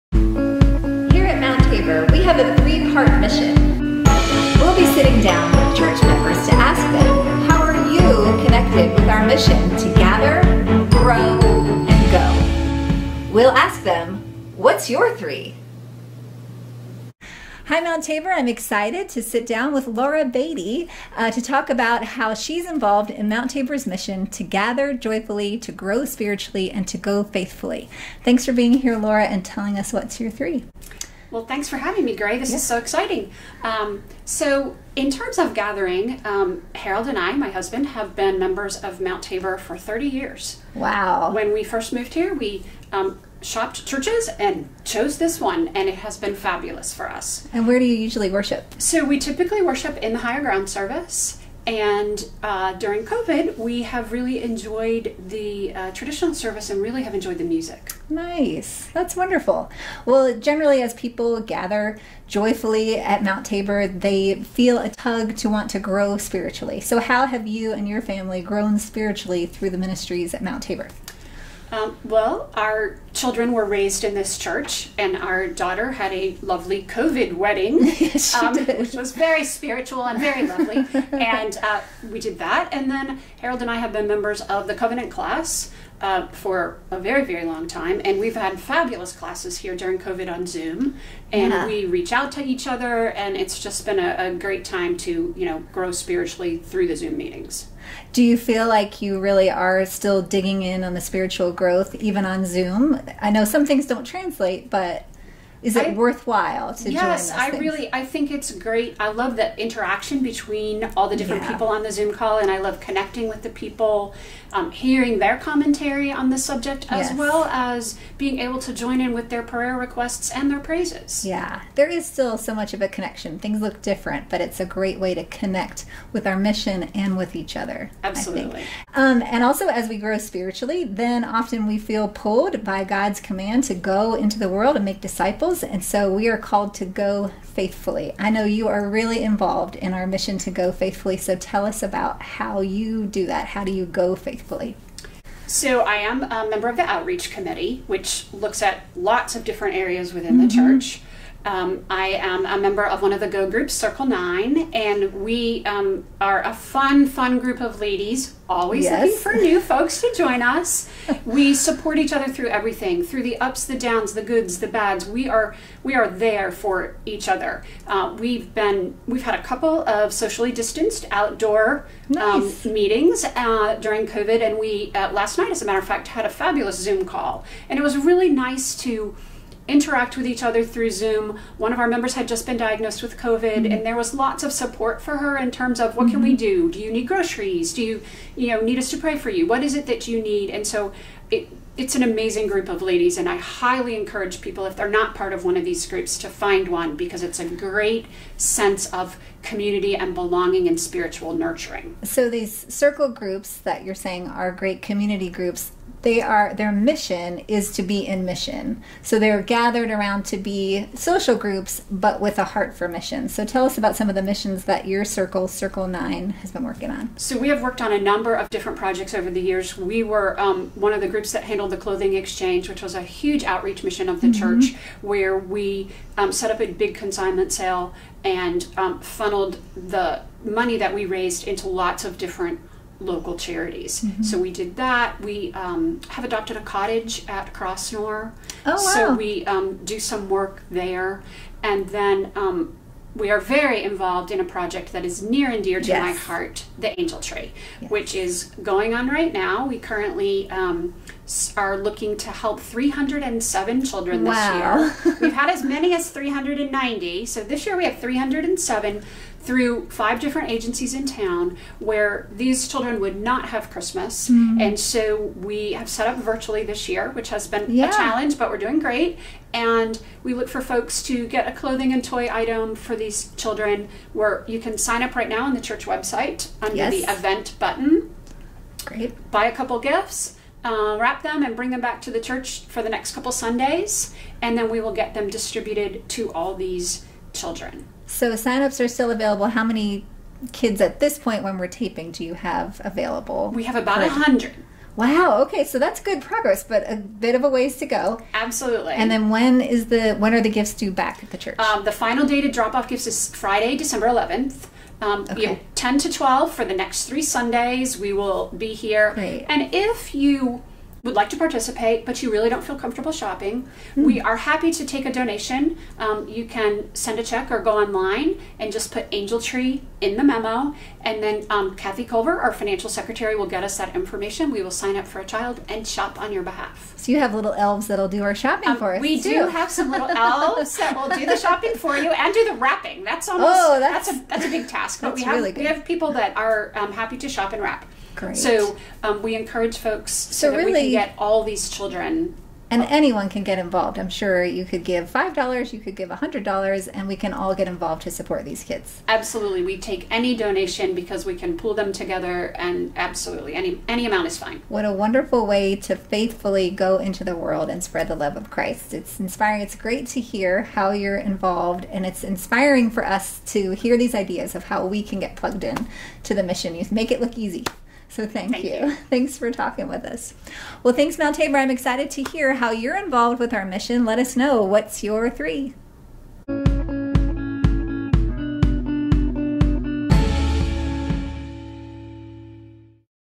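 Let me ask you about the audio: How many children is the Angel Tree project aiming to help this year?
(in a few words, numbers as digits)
307.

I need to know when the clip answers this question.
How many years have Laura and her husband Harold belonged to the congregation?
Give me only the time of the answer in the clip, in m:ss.
0:39.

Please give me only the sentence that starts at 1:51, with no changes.
people on the zoom call and i love connecting with the people um, hearing their commentary on the subject as yes.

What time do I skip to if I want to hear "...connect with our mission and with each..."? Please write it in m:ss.
2:05.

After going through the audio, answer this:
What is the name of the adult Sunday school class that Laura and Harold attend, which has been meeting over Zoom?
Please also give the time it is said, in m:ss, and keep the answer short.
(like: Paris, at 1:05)
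Covenant class, at 1:24.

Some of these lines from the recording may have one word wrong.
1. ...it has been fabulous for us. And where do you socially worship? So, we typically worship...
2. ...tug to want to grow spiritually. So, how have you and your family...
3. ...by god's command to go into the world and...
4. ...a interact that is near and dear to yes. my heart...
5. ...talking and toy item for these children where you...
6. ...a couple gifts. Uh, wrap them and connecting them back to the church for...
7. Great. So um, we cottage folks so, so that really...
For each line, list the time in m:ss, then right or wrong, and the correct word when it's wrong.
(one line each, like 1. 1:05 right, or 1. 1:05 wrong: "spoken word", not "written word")
1. 0:45 wrong: "usually", not "socially"
2. 1:04 right
3. 2:12 right
4. 4:04 wrong: "project", not "interact"
5. 4:31 wrong: "clothing", not "talking"
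6. 4:39 wrong: "bring", not "connecting"
7. 5:38 wrong: "encourage", not "cottage".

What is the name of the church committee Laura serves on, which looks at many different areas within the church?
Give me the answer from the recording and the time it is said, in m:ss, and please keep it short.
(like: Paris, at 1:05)
Outreach Committee, at 2:26.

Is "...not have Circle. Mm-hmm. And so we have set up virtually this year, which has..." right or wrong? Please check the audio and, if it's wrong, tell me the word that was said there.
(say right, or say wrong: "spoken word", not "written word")
wrong: "Christmas", not "Circle".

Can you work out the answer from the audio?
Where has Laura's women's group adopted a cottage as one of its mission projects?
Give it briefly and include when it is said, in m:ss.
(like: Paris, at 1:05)
Crossnore, at 3:57.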